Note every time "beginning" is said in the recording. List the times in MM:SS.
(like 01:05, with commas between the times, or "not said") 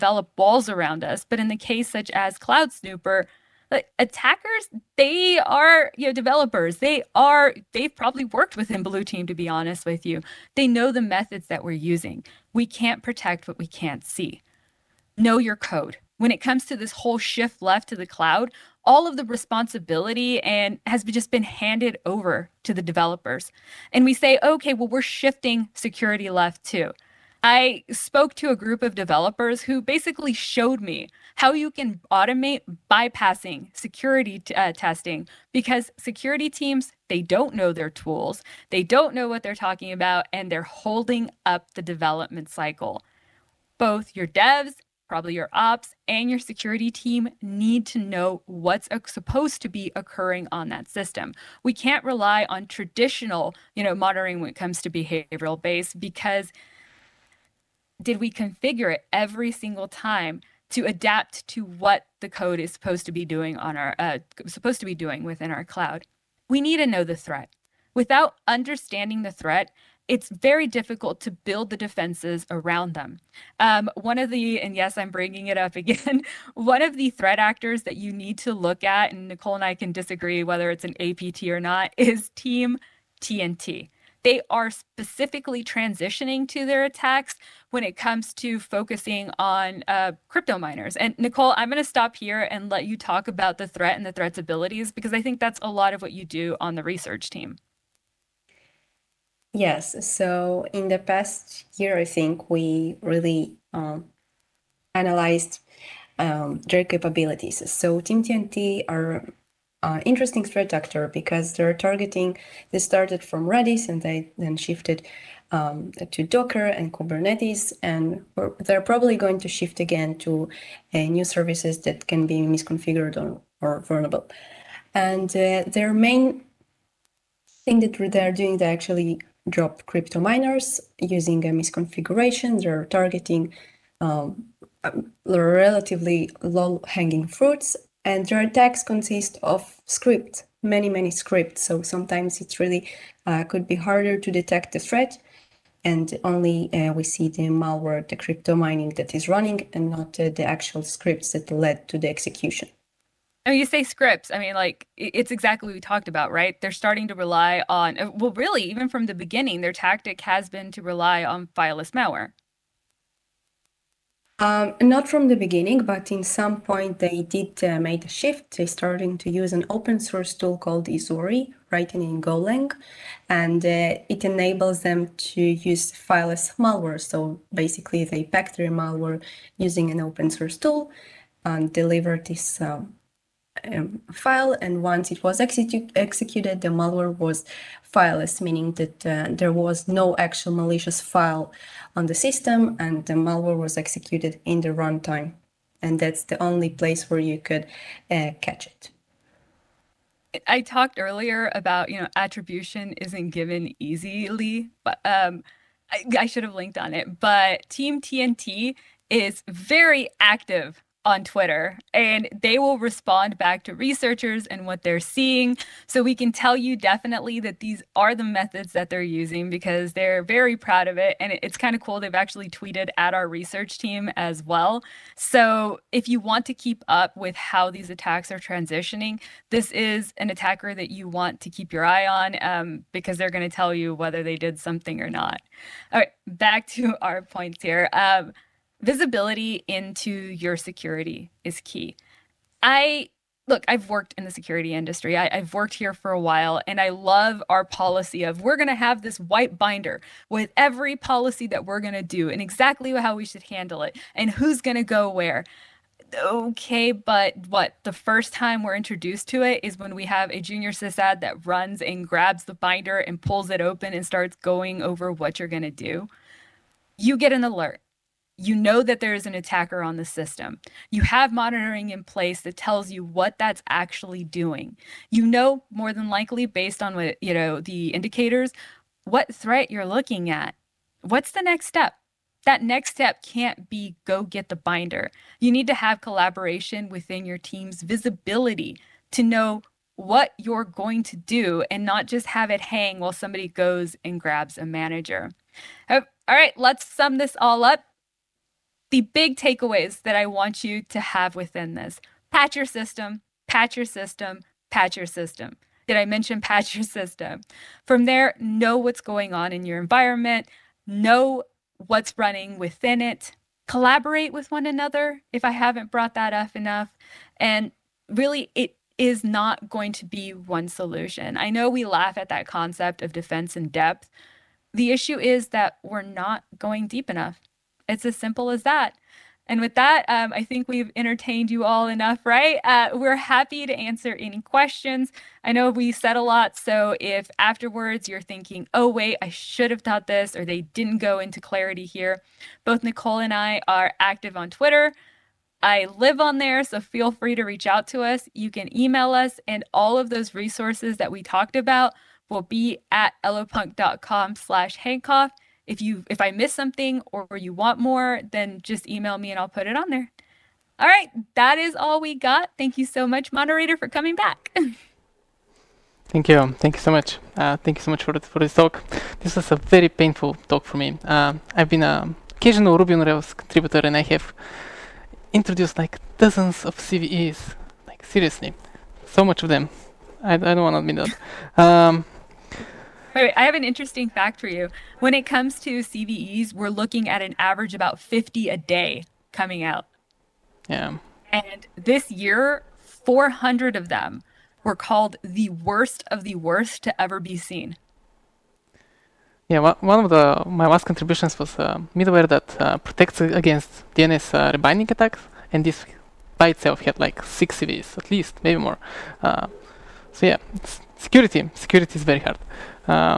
02:39, 02:45.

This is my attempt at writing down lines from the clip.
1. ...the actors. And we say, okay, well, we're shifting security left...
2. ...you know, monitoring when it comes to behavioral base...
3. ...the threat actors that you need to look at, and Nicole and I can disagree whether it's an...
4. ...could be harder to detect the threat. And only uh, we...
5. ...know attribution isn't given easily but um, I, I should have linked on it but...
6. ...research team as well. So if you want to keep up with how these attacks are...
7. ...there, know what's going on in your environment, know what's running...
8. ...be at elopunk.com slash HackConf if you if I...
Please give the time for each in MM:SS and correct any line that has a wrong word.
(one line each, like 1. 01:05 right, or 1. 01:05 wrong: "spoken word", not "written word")
1. 00:22 wrong: "developers", not "actors"
2. 00:53 right
3. 01:16 right
4. 02:23 right
5. 03:21 right
6. 03:43 right
7. 05:08 right
8. 05:52 right.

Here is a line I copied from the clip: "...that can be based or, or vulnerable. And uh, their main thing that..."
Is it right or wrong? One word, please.
wrong.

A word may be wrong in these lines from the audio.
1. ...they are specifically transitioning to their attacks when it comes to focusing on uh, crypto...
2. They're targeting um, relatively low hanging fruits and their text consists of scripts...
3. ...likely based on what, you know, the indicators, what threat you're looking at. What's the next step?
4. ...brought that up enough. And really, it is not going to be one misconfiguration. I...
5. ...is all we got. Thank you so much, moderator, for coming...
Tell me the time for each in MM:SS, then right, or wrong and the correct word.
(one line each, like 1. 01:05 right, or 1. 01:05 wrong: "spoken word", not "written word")
1. 01:24 right
2. 02:12 right
3. 04:36 right
4. 05:15 wrong: "solution", not "misconfiguration"
5. 06:01 right.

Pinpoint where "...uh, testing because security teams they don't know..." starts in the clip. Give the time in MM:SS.
00:34.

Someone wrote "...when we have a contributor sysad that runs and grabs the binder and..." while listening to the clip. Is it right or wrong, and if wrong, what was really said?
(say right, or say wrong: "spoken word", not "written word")
wrong: "junior", not "contributor".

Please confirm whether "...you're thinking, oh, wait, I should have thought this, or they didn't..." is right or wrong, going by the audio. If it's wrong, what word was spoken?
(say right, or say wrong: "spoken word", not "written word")
right.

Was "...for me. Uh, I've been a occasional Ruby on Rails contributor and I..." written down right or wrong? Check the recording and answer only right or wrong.
right.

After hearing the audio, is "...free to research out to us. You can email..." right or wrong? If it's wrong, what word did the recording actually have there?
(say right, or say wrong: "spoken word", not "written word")
wrong: "reach", not "research".